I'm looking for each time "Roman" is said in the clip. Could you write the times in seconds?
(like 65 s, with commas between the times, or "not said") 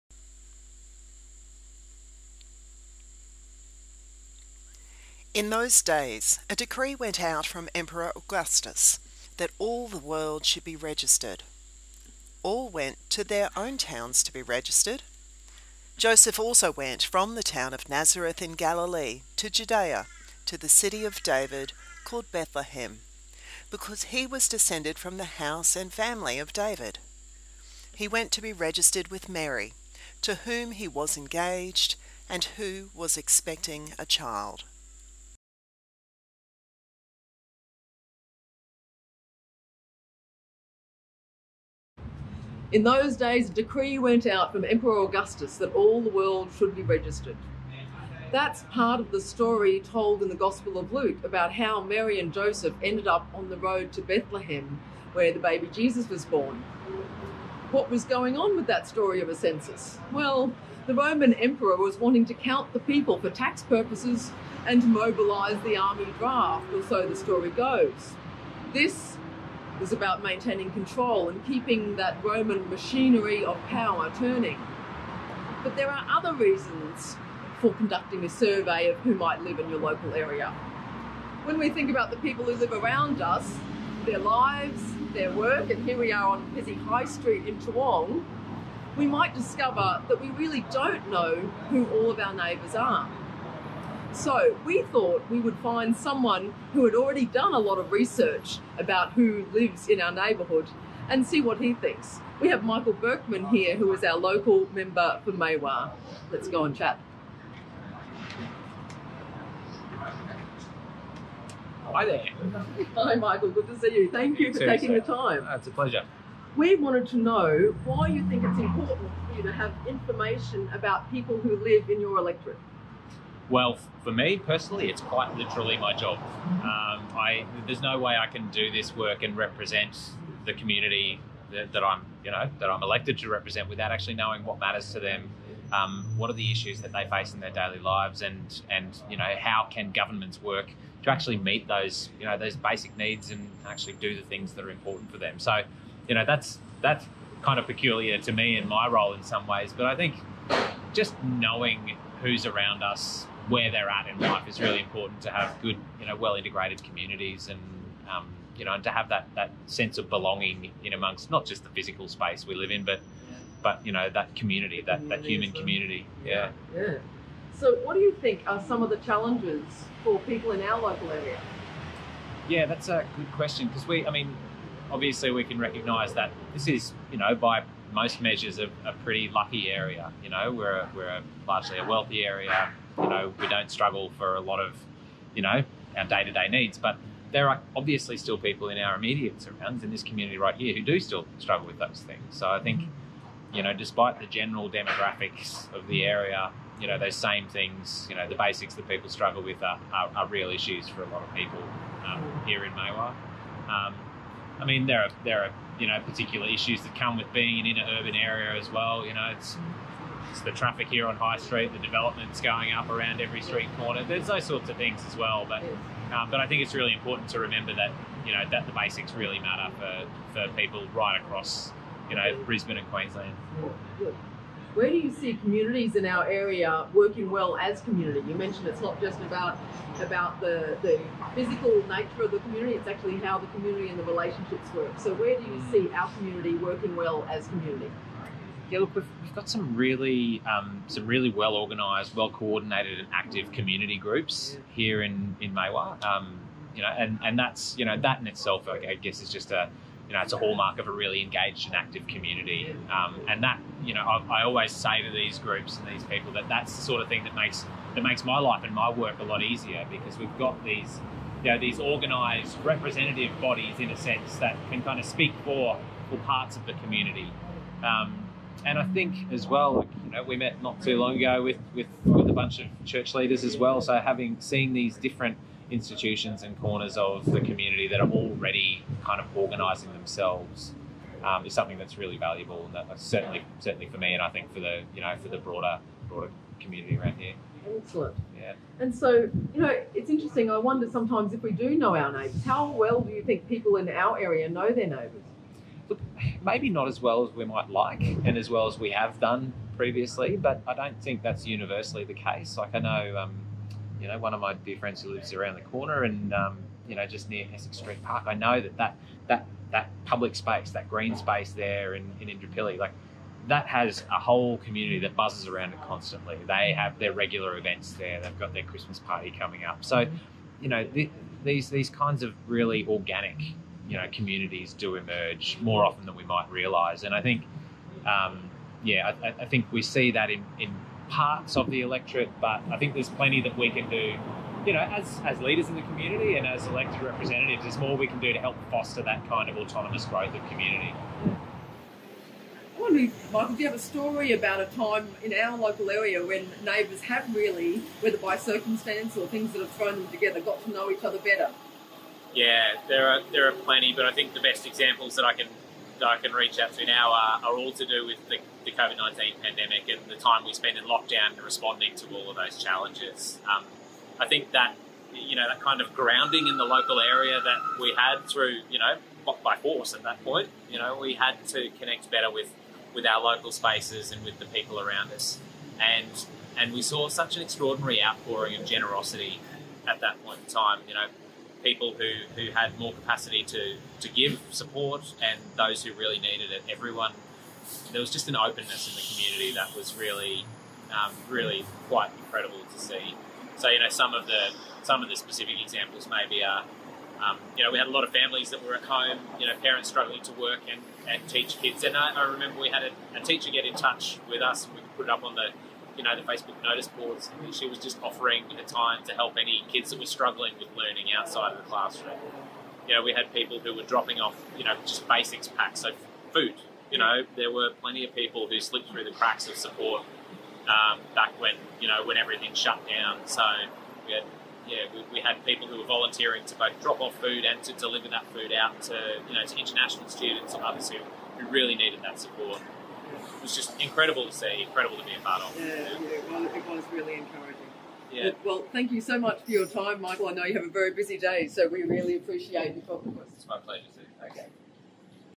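60 s, 72 s.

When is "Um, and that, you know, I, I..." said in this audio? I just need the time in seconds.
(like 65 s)
252 s.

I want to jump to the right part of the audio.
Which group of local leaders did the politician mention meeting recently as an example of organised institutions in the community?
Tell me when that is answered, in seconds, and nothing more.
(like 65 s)
272 s.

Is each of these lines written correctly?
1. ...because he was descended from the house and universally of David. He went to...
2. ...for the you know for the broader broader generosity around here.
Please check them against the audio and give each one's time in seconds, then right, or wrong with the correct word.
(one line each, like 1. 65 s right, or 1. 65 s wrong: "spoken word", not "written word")
1. 23 s wrong: "family", not "universally"
2. 284 s wrong: "community", not "generosity".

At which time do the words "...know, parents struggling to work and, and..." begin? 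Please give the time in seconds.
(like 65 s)
399 s.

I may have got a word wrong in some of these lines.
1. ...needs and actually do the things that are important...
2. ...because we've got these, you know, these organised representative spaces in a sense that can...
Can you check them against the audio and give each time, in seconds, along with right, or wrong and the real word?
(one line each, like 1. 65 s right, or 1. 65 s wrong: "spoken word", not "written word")
1. 142 s right
2. 259 s wrong: "bodies", not "spaces".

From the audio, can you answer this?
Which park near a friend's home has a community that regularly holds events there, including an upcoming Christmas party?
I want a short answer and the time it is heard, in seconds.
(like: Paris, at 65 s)
Essex Street Park, at 307 s.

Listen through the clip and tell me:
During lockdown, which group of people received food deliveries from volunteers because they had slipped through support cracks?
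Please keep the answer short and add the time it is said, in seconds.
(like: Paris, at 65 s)
international students, at 429 s.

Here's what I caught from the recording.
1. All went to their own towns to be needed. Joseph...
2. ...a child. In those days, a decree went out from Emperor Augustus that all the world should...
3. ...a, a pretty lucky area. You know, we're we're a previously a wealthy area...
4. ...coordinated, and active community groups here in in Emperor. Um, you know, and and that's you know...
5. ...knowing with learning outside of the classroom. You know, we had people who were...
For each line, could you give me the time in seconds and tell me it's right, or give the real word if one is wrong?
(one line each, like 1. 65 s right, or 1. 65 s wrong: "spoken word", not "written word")
1. 12 s wrong: "registered", not "needed"
2. 33 s right
3. 178 s wrong: "largely", not "previously"
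4. 242 s wrong: "Maiwar", not "Emperor"
5. 410 s wrong: "struggling", not "knowing".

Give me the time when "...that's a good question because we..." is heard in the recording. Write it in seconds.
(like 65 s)
172 s.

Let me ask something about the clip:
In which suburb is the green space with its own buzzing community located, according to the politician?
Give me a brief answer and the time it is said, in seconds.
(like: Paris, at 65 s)
Indooroopilly, at 312 s.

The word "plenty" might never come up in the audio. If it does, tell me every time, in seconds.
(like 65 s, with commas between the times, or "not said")
333 s, 353 s, 417 s.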